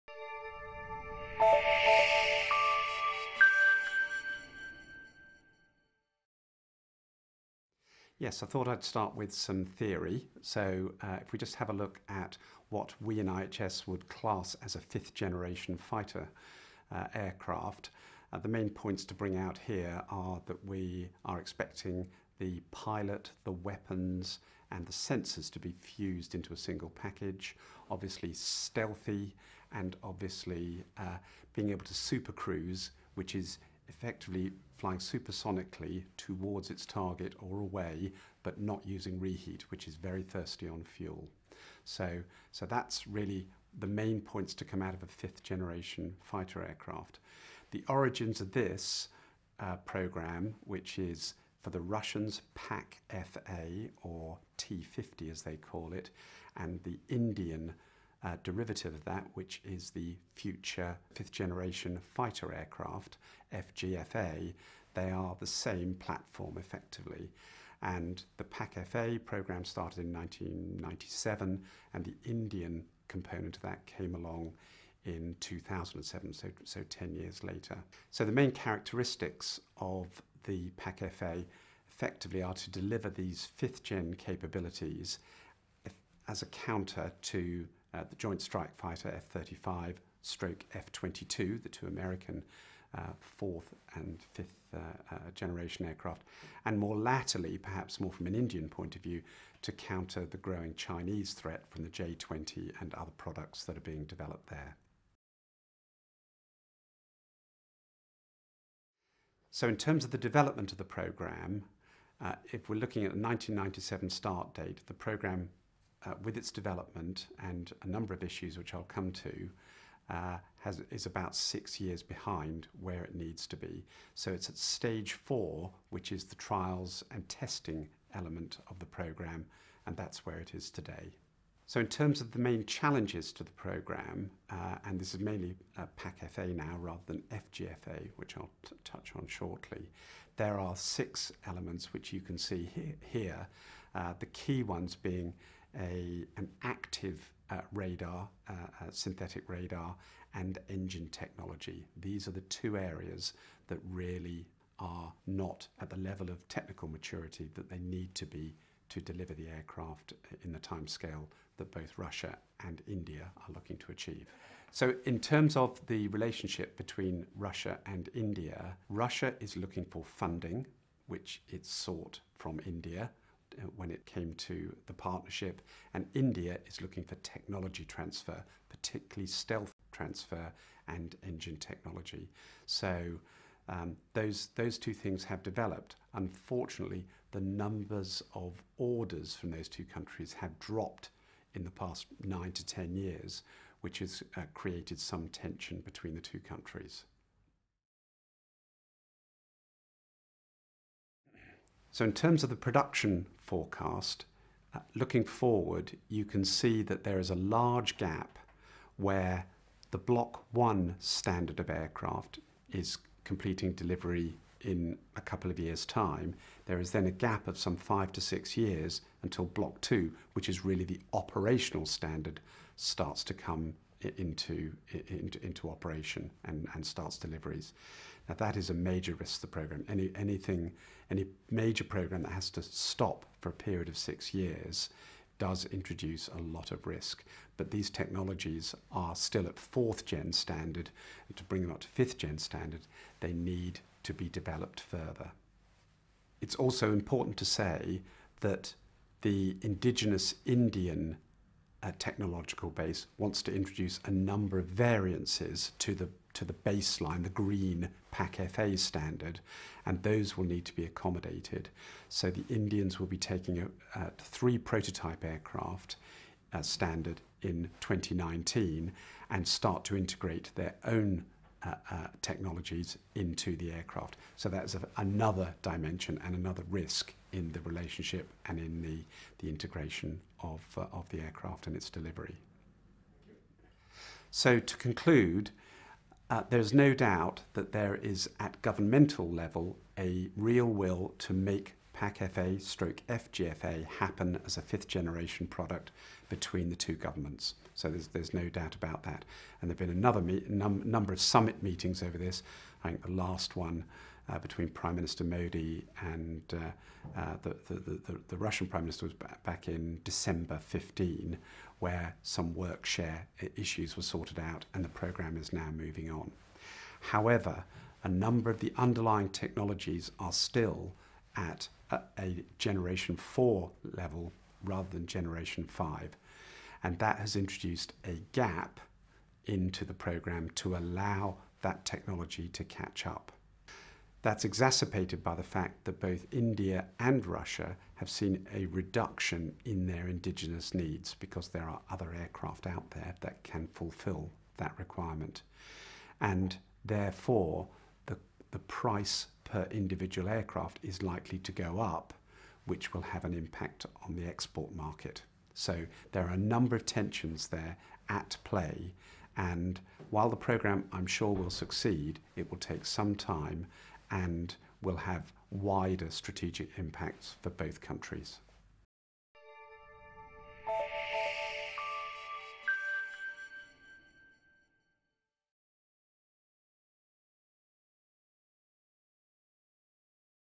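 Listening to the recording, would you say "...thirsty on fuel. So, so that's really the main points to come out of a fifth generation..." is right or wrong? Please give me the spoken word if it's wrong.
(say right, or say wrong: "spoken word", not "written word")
right.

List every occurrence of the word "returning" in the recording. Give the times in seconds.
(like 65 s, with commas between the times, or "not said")
not said.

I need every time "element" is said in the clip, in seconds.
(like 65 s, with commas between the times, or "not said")
128 s, 141 s.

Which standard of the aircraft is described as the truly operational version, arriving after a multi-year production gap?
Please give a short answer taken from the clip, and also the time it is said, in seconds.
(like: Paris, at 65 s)
Block 2, at 219 s.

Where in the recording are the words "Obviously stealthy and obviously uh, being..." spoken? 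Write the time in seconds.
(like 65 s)
27 s.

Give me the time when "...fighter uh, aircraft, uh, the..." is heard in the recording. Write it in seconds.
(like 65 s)
15 s.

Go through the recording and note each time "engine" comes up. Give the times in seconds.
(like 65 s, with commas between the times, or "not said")
150 s, 181 s.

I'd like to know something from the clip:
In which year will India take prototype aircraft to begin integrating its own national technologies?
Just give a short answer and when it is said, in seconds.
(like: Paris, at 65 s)
2019, at 267 s.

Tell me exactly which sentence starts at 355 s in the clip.
So there are a number of tensions there at play.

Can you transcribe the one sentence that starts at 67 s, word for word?
And the PAK-FA program started in 1997, and the Indian component of that came along in 2007, so, so 10 years later.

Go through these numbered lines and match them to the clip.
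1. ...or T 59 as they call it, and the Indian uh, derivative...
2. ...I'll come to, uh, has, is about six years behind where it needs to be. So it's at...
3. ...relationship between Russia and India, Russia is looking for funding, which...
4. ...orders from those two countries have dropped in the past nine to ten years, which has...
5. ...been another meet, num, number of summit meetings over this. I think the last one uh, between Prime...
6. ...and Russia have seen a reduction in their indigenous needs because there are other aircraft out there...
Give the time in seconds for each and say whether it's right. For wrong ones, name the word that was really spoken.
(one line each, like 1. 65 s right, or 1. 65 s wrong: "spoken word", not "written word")
1. 54 s wrong: "50", not "59"
2. 118 s right
3. 166 s right
4. 188 s right
5. 299 s right
6. 336 s right.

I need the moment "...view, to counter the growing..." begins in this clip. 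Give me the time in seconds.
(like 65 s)
99 s.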